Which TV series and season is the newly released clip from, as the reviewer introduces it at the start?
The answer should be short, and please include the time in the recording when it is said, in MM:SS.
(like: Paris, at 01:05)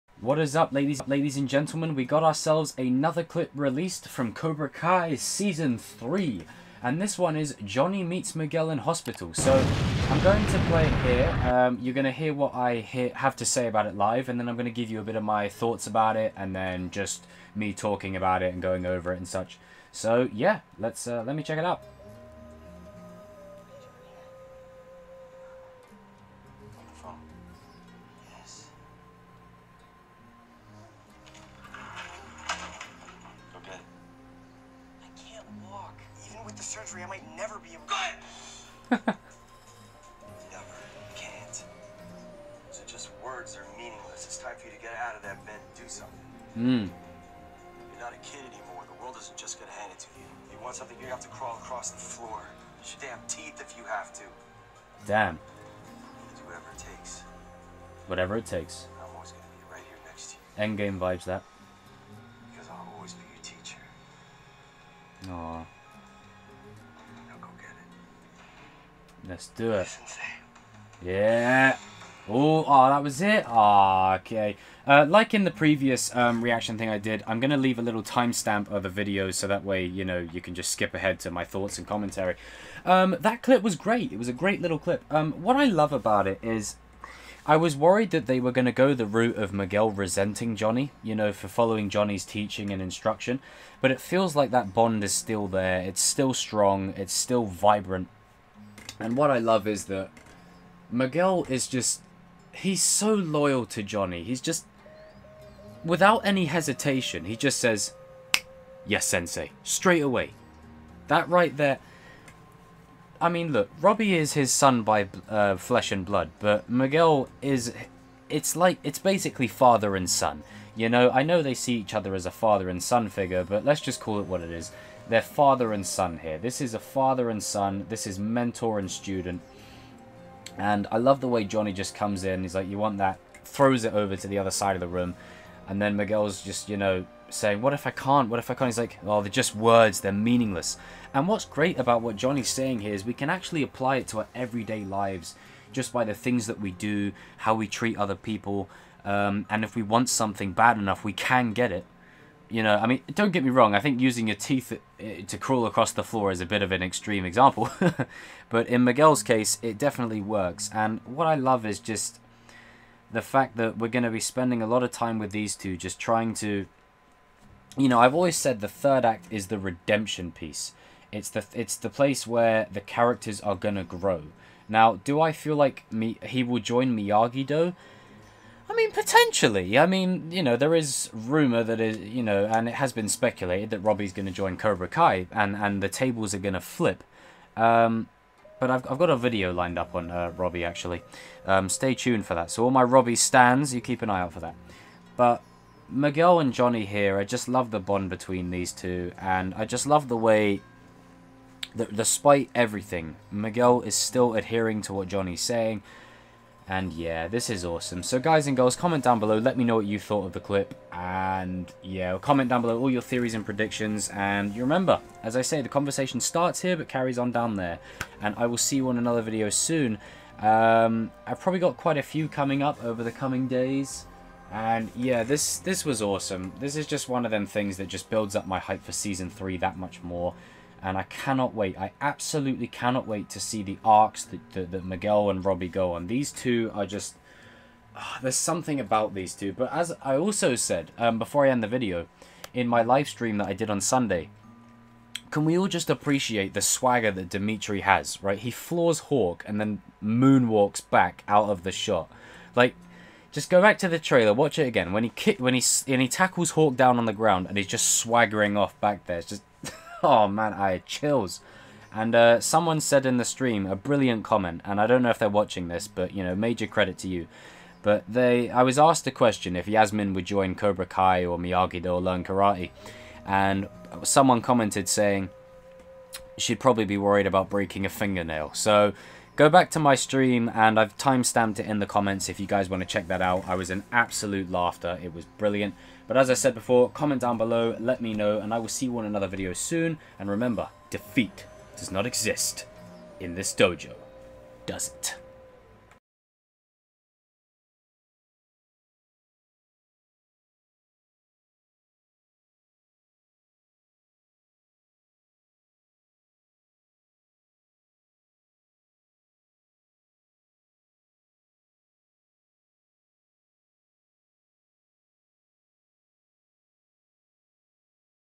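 Cobra Kai Season 3, at 00:04.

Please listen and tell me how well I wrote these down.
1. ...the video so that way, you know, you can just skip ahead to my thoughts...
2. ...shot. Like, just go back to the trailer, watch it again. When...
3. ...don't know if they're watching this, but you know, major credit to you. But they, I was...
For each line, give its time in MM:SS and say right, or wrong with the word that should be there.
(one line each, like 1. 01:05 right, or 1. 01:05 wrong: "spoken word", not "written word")
1. 01:18 right
2. 04:11 right
3. 04:24 right.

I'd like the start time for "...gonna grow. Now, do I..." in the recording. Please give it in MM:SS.
02:53.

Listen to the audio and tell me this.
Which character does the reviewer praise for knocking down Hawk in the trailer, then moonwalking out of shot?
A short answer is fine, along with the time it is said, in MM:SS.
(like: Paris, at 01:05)
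Demetri, at 04:07.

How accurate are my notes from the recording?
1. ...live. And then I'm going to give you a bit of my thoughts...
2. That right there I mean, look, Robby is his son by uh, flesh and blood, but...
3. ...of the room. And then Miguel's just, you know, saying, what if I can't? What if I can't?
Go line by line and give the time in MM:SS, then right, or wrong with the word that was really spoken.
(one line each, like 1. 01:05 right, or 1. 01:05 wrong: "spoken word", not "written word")
1. 00:13 right
2. 01:51 right
3. 02:14 right.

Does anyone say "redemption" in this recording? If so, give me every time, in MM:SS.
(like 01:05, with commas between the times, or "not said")
02:49.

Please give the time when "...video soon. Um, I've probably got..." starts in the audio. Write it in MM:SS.
03:39.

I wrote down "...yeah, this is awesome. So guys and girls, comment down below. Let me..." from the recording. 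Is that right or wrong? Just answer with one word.
right.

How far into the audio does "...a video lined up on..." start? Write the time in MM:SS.
03:09.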